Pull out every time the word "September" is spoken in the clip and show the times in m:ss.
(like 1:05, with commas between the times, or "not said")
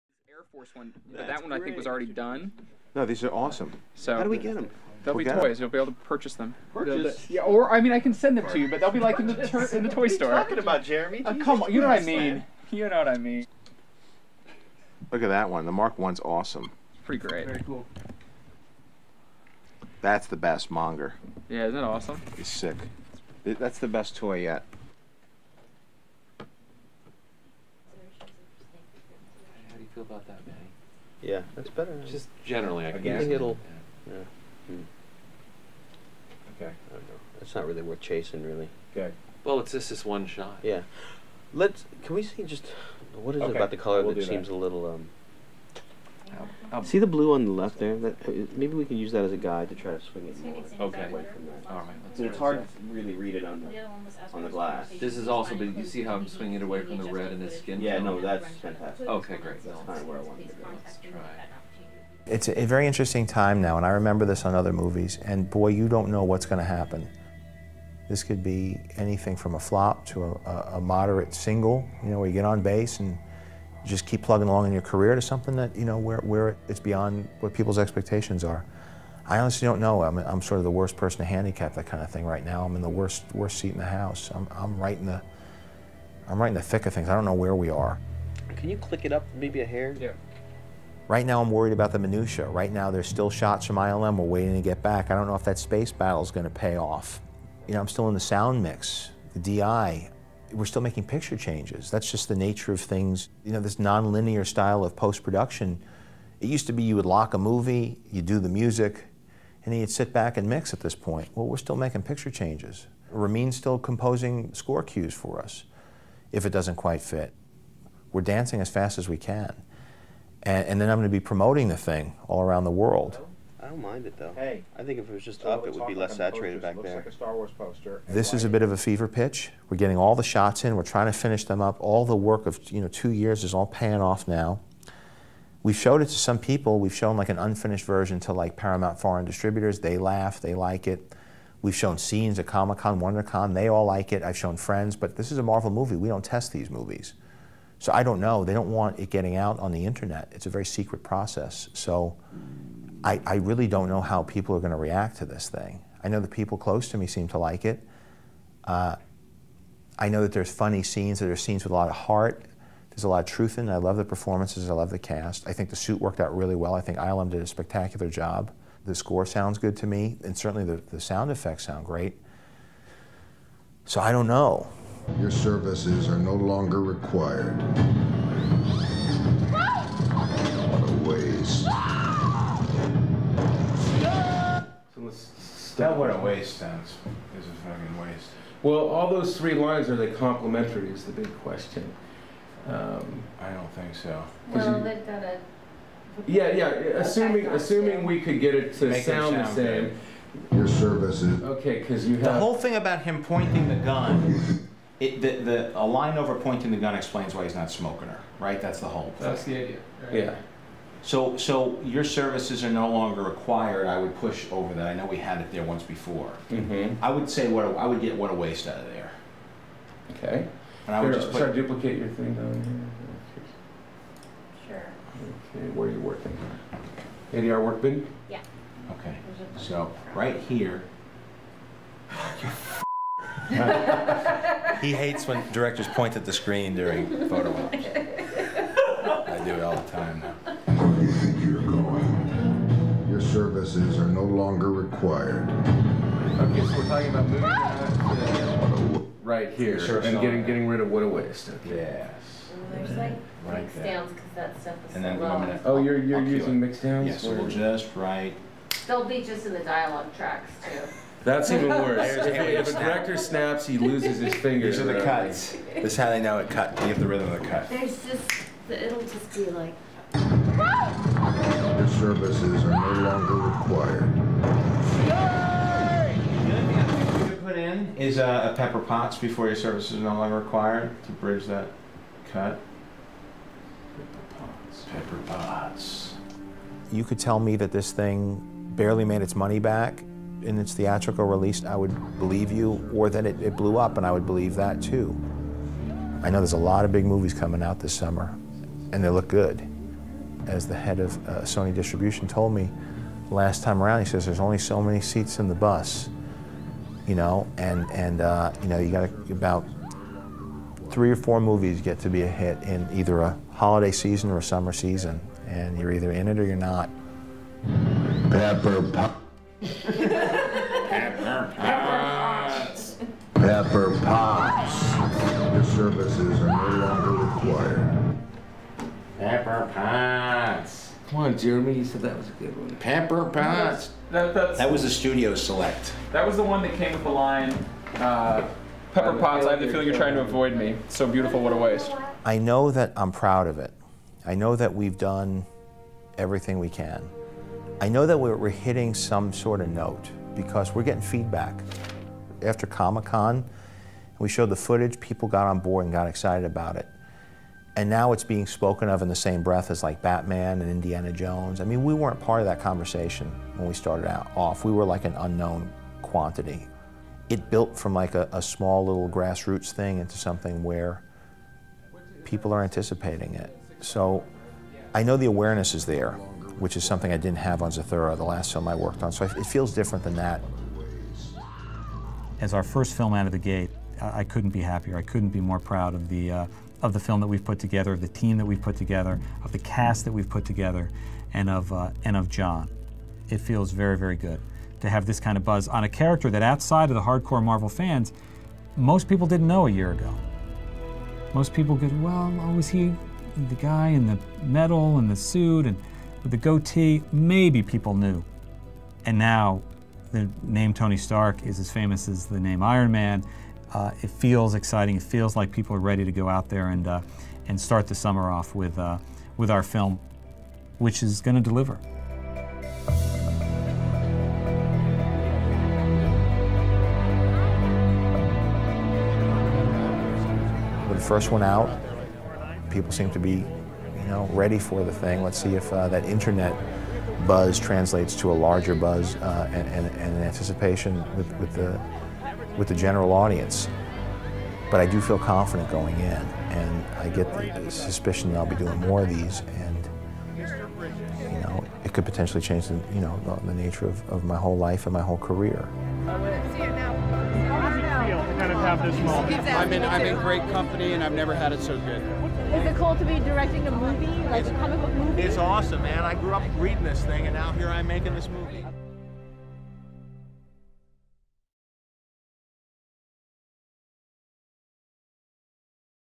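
not said.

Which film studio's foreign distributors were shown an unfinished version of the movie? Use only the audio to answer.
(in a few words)
Paramount.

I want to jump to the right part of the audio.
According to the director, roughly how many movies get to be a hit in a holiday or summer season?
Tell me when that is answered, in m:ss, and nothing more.
5:10.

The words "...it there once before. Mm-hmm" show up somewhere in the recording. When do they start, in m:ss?
3:35.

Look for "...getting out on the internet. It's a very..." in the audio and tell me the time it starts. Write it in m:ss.
2:29.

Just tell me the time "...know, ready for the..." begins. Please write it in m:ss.
7:14.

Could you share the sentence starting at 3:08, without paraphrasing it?
Well, all those three lines are they complementary?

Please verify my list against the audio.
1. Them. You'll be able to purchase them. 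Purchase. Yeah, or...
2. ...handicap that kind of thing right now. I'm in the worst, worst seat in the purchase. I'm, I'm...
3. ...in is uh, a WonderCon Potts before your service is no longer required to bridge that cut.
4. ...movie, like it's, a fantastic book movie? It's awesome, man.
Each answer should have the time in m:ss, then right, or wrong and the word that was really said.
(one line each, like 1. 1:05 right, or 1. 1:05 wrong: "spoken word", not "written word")
1. 0:05 right
2. 1:21 wrong: "house", not "purchase"
3. 4:37 wrong: "Pepper", not "WonderCon"
4. 7:43 wrong: "comic", not "fantastic".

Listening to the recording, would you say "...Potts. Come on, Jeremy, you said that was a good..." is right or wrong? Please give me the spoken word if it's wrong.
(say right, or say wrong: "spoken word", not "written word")
right.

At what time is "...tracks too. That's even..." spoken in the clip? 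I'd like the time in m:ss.
4:20.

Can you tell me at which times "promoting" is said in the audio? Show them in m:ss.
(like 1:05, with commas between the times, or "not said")
2:01.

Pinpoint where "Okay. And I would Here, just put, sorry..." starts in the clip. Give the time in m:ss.
3:40.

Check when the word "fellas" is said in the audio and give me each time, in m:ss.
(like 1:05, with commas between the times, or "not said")
not said.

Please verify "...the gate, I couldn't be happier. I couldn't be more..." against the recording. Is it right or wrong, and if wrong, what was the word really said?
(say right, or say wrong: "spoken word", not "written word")
right.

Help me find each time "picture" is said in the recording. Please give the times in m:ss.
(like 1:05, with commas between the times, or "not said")
1:41, 1:52.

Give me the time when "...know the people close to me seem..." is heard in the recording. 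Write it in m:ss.
2:36.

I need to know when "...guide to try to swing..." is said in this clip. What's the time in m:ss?
0:49.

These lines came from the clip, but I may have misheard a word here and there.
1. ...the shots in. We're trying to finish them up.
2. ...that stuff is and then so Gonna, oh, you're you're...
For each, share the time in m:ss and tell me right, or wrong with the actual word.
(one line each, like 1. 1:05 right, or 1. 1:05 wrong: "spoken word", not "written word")
1. 2:10 right
2. 4:14 right.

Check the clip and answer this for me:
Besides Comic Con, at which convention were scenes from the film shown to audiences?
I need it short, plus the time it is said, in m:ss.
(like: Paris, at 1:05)
WonderCon, at 2:22.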